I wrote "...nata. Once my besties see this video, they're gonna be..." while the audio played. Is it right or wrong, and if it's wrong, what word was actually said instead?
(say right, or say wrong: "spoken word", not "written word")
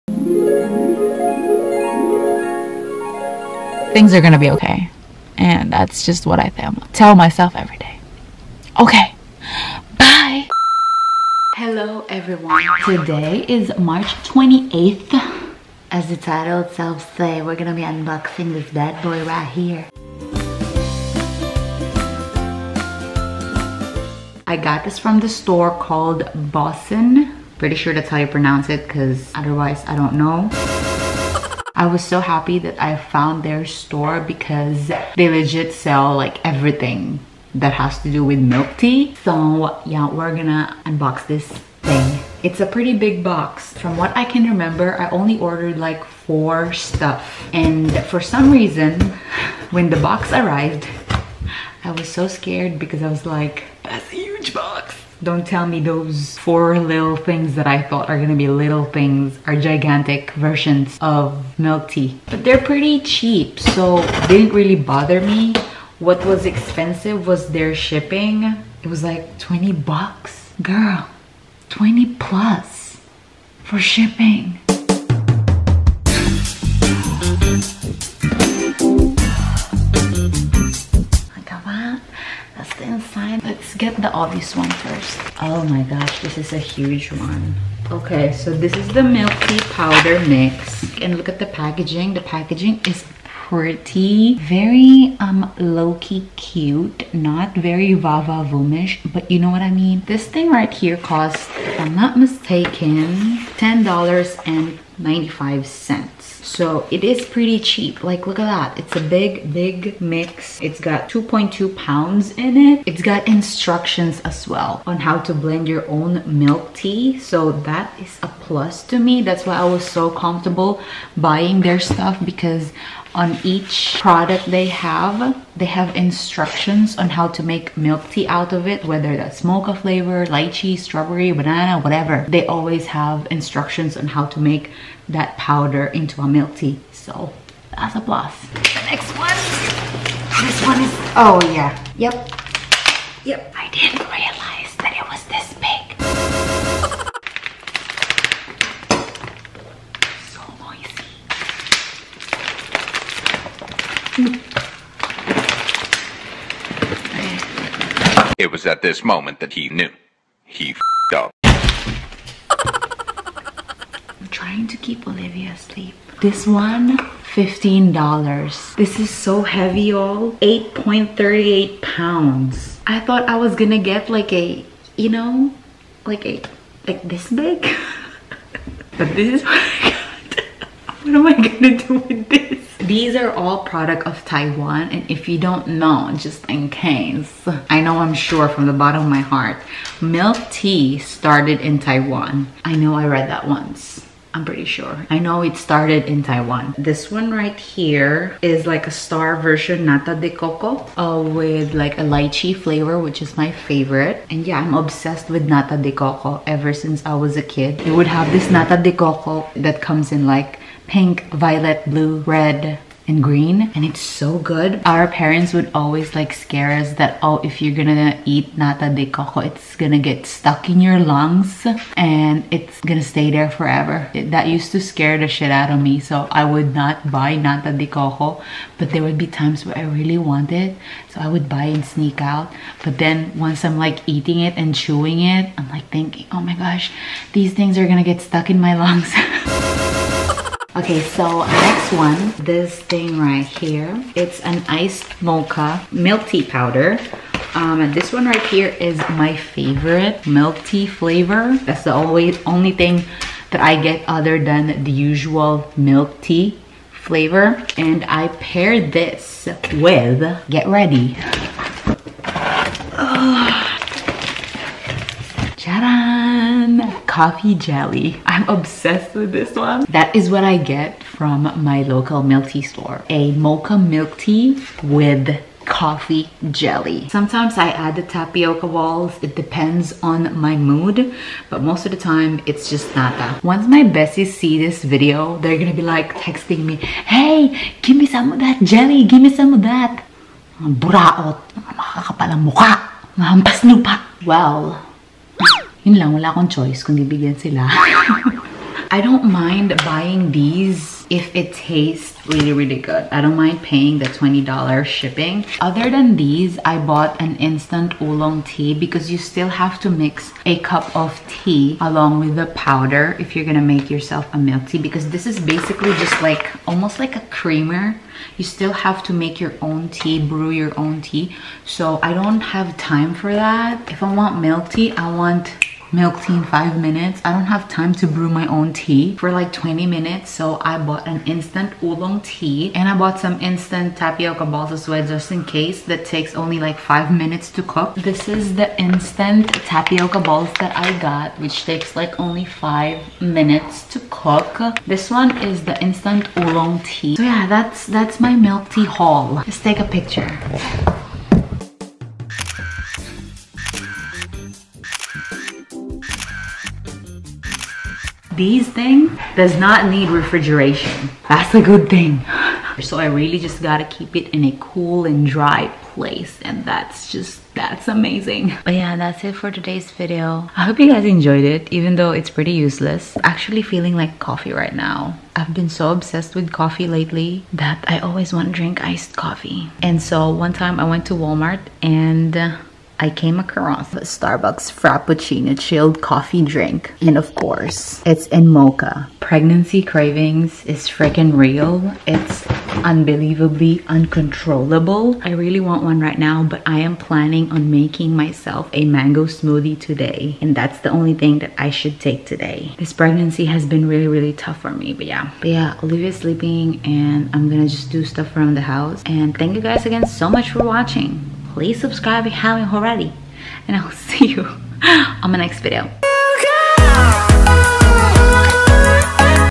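right.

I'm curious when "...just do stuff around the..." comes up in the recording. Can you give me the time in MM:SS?
06:47.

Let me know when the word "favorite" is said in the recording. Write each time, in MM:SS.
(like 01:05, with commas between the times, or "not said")
03:23, 04:09.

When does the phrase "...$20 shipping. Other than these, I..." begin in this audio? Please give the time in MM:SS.
05:04.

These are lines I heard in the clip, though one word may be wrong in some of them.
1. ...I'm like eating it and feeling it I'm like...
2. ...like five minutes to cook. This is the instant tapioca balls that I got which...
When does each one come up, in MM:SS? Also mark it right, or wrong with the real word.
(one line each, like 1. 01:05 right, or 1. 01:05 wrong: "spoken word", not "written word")
1. 03:53 wrong: "chewing", not "feeling"
2. 05:36 right.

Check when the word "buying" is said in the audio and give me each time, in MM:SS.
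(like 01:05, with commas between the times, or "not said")
02:01, 04:59.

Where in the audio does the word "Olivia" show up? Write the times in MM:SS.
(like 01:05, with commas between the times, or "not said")
02:45, 06:45.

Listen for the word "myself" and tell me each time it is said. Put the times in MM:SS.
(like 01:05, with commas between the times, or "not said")
00:07, 06:38.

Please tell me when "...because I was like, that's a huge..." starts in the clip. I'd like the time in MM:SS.
00:52.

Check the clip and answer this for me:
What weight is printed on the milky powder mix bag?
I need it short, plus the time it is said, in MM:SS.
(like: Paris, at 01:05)
2.2 pounds, at 01:51.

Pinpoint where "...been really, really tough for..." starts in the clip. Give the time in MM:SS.
06:43.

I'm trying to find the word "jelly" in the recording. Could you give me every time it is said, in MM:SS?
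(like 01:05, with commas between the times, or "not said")
04:27, 04:36, 04:48.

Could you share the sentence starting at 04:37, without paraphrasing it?
Sometimes I add the tapioca balls.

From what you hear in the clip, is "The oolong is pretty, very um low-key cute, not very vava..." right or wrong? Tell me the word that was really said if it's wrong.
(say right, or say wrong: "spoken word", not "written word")
wrong: "packaging", not "oolong".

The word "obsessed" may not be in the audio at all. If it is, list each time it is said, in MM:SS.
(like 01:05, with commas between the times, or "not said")
03:24, 04:28, 06:15.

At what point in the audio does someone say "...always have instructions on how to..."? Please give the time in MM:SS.
02:12.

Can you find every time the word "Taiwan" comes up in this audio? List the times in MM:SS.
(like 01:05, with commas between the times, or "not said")
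03:04, 03:11, 03:16.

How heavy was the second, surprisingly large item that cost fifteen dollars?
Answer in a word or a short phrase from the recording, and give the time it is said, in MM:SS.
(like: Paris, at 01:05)
8.38 pounds, at 02:50.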